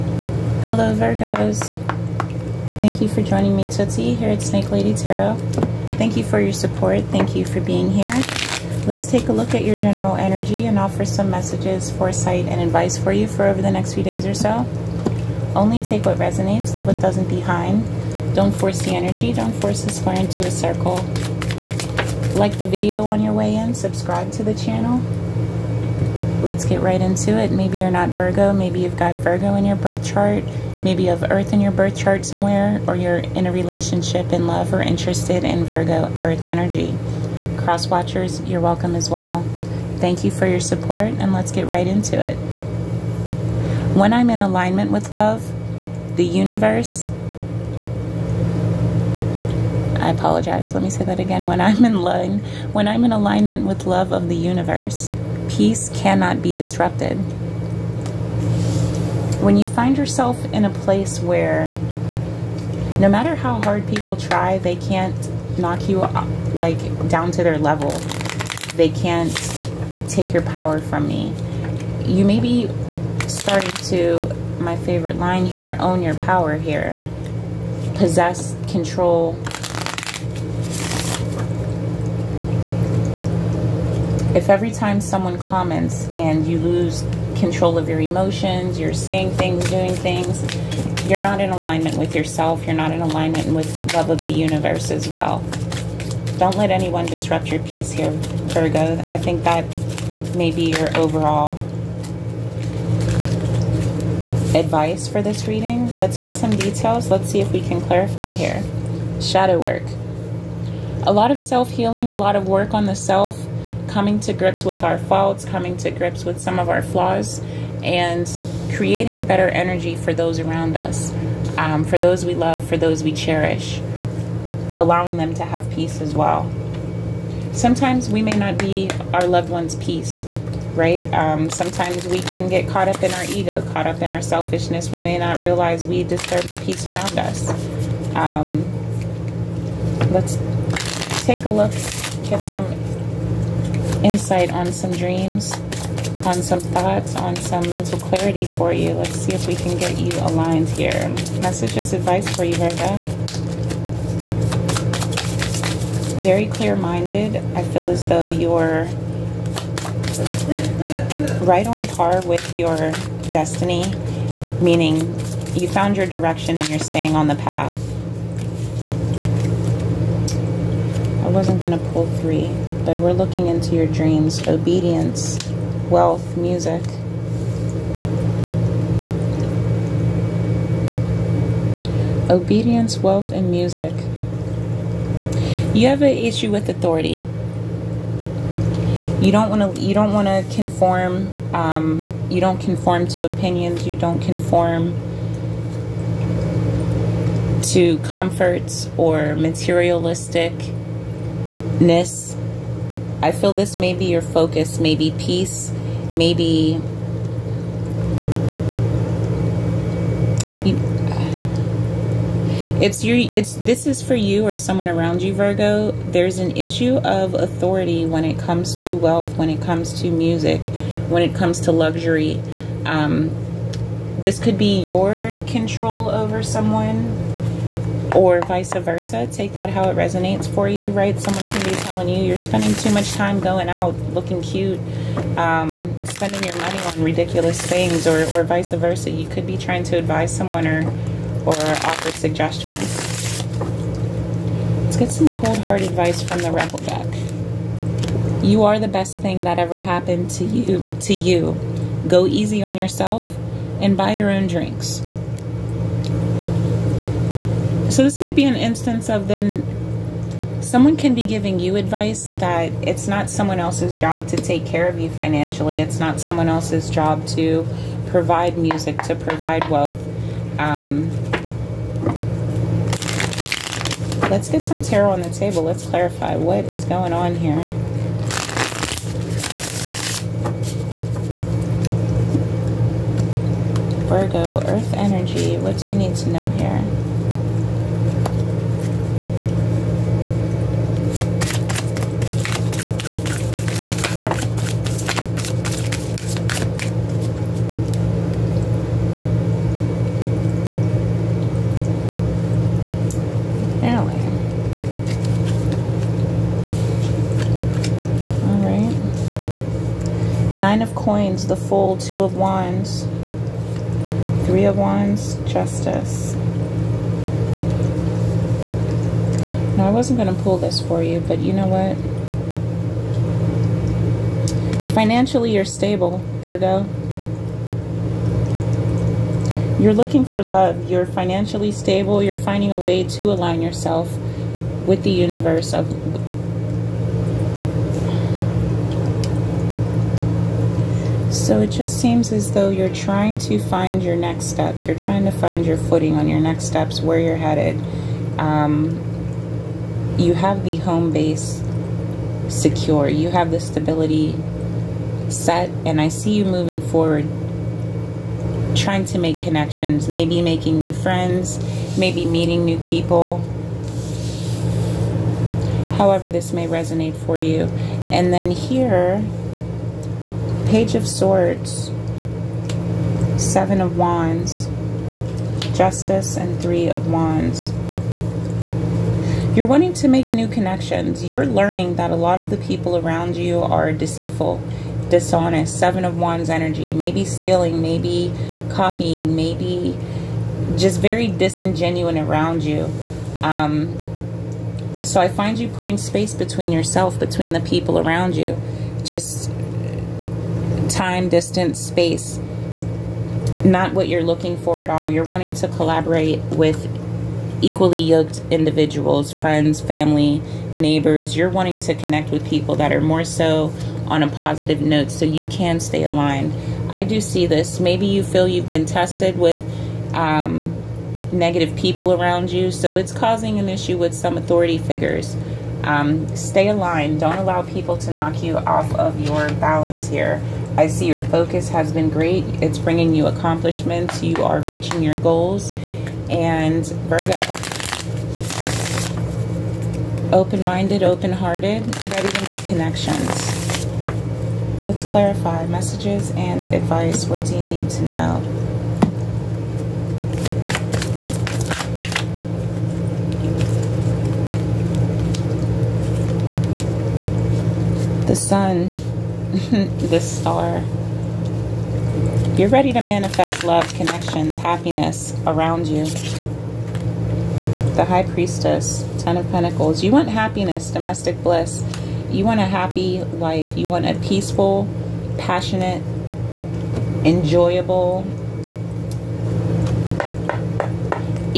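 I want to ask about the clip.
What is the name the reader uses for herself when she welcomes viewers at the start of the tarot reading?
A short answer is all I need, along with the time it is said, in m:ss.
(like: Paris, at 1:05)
Tootsie, at 0:03.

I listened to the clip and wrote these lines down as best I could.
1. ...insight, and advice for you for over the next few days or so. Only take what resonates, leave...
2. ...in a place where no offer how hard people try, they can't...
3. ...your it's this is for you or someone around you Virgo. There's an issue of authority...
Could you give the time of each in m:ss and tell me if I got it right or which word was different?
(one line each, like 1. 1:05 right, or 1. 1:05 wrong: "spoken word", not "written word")
1. 0:11 wrong: "foresight", not "insight"
2. 1:00 wrong: "matter", not "offer"
3. 3:33 right.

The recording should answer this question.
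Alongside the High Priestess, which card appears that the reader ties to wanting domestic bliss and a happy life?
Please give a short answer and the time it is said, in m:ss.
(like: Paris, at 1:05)
Ten of Pentacles, at 7:49.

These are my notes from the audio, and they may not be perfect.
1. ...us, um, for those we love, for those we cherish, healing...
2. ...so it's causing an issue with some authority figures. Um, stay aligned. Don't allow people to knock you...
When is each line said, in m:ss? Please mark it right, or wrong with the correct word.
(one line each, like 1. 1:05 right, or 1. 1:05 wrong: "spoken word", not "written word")
1. 2:00 wrong: "allowing", not "healing"
2. 7:02 right.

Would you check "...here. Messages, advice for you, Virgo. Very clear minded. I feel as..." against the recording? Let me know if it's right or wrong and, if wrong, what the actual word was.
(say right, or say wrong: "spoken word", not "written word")
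right.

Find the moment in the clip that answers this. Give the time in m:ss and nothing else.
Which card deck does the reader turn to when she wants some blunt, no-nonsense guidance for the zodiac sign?
4:06.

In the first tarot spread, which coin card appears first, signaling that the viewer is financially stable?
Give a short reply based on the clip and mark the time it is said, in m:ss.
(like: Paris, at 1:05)
Nine of Coins, at 5:10.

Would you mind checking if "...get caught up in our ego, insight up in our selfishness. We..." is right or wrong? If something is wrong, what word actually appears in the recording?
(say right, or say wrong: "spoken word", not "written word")
wrong: "caught", not "insight".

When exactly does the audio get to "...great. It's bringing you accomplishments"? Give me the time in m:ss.
7:12.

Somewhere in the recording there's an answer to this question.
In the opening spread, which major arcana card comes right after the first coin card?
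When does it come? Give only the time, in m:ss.
5:11.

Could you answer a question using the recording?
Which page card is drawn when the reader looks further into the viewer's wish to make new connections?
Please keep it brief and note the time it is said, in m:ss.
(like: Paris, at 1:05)
Page of Swords, at 6:10.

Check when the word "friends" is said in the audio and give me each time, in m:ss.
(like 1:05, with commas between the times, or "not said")
6:00, 6:49.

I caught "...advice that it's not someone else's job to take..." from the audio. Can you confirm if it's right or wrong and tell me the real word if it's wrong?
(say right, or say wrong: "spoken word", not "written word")
right.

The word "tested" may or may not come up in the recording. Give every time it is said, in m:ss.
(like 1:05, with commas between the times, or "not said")
6:58.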